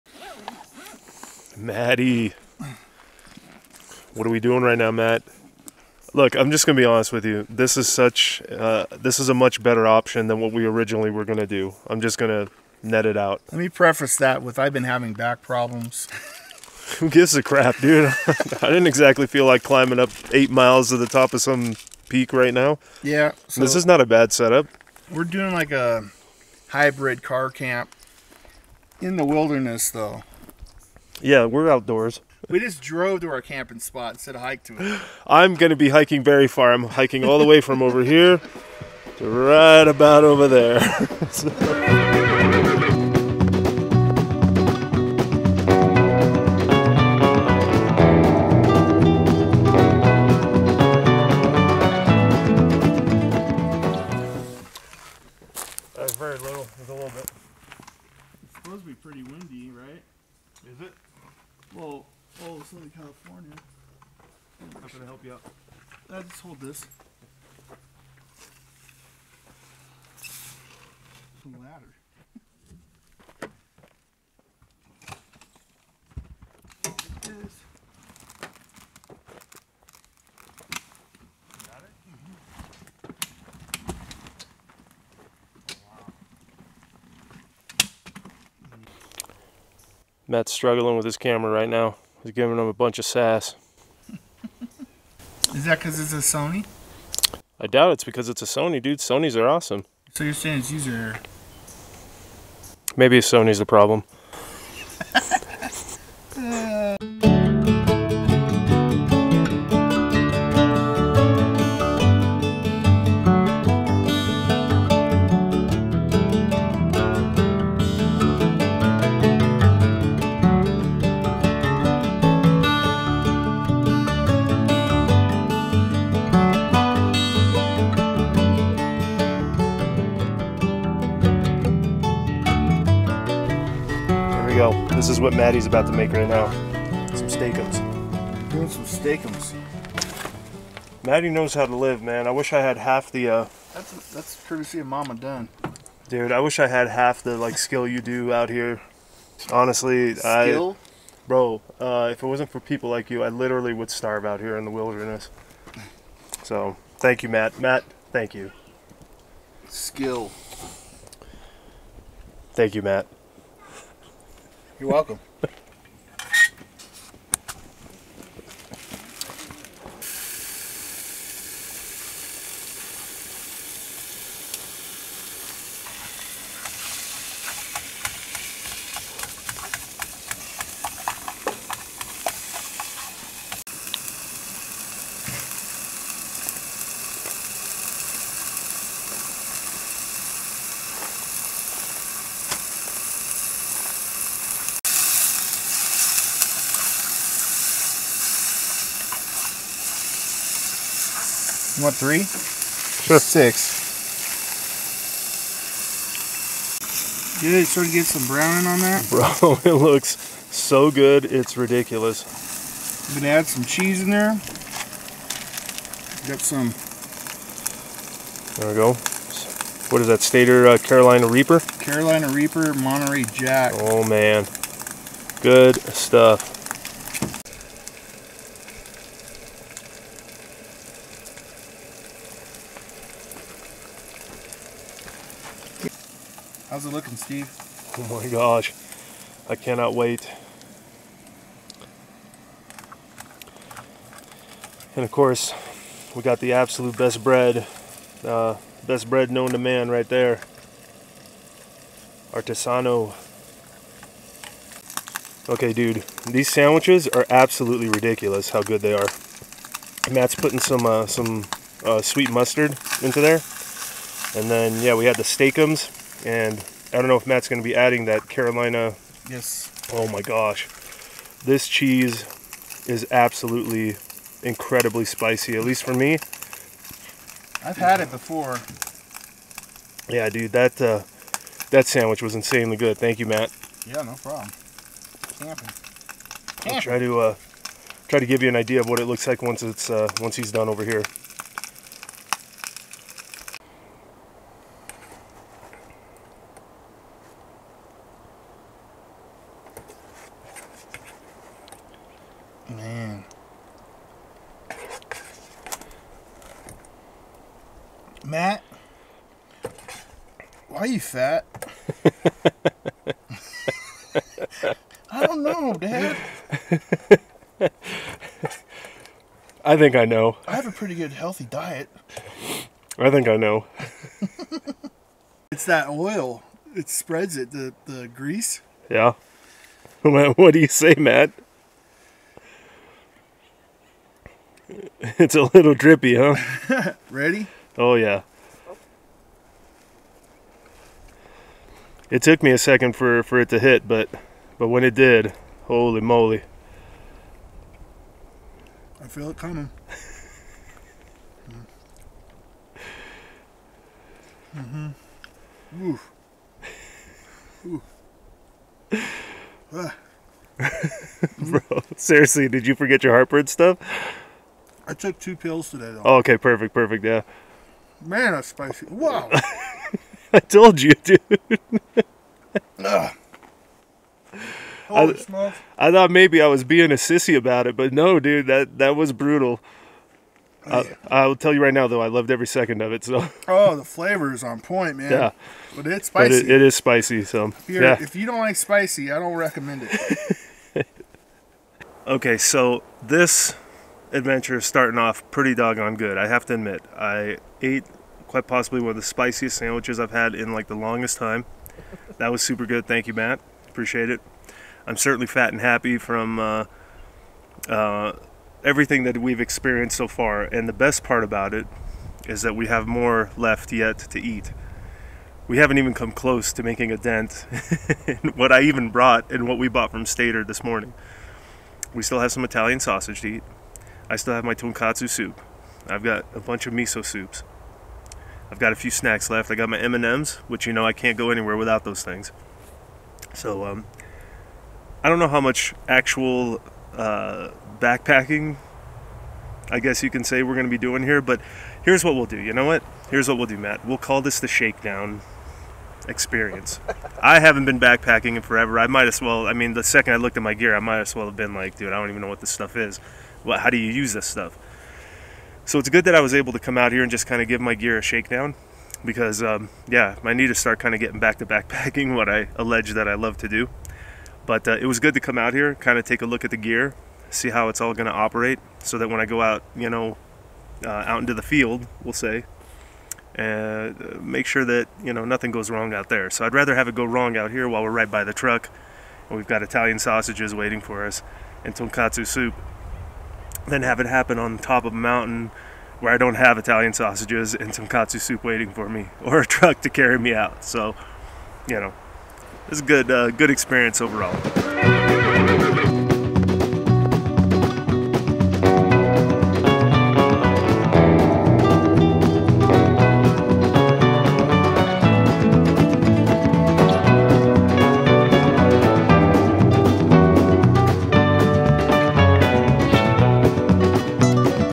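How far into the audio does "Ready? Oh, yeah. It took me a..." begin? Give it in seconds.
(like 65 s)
337 s.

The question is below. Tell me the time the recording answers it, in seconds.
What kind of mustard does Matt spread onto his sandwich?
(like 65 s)
262 s.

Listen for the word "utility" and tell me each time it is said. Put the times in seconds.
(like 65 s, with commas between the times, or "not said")
not said.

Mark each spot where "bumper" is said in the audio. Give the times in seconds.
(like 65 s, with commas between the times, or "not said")
not said.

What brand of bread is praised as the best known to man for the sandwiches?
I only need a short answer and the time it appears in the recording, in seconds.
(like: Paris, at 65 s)
Artesano, at 252 s.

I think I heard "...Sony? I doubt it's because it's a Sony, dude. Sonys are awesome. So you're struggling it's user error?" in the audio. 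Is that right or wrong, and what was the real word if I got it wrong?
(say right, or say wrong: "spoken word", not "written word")
wrong: "saying", not "struggling".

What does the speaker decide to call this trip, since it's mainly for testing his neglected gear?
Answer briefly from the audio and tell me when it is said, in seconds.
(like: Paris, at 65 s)
The shakedown experience, at 444 s.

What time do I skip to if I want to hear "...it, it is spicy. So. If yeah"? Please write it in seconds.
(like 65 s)
386 s.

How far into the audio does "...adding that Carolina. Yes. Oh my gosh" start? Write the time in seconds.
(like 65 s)
267 s.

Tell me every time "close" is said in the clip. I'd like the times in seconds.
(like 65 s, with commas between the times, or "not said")
416 s.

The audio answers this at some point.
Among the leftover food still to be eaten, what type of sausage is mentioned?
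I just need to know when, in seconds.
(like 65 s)
422 s.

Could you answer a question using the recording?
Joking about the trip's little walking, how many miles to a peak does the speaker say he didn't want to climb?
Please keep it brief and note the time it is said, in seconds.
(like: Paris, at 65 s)
8, at 20 s.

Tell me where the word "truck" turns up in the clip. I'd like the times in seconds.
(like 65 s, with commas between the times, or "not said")
478 s, 489 s.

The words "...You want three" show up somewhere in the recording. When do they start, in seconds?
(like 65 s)
201 s.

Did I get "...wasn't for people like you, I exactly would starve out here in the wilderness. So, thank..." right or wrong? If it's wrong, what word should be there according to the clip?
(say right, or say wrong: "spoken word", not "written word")
wrong: "literally", not "exactly".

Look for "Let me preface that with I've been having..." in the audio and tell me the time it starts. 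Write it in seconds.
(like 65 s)
13 s.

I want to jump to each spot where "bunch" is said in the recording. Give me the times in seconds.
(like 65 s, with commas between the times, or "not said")
92 s, 426 s.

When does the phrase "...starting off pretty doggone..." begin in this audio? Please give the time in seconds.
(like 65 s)
394 s.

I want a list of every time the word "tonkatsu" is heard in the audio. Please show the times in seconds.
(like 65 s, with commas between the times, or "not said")
424 s, 481 s.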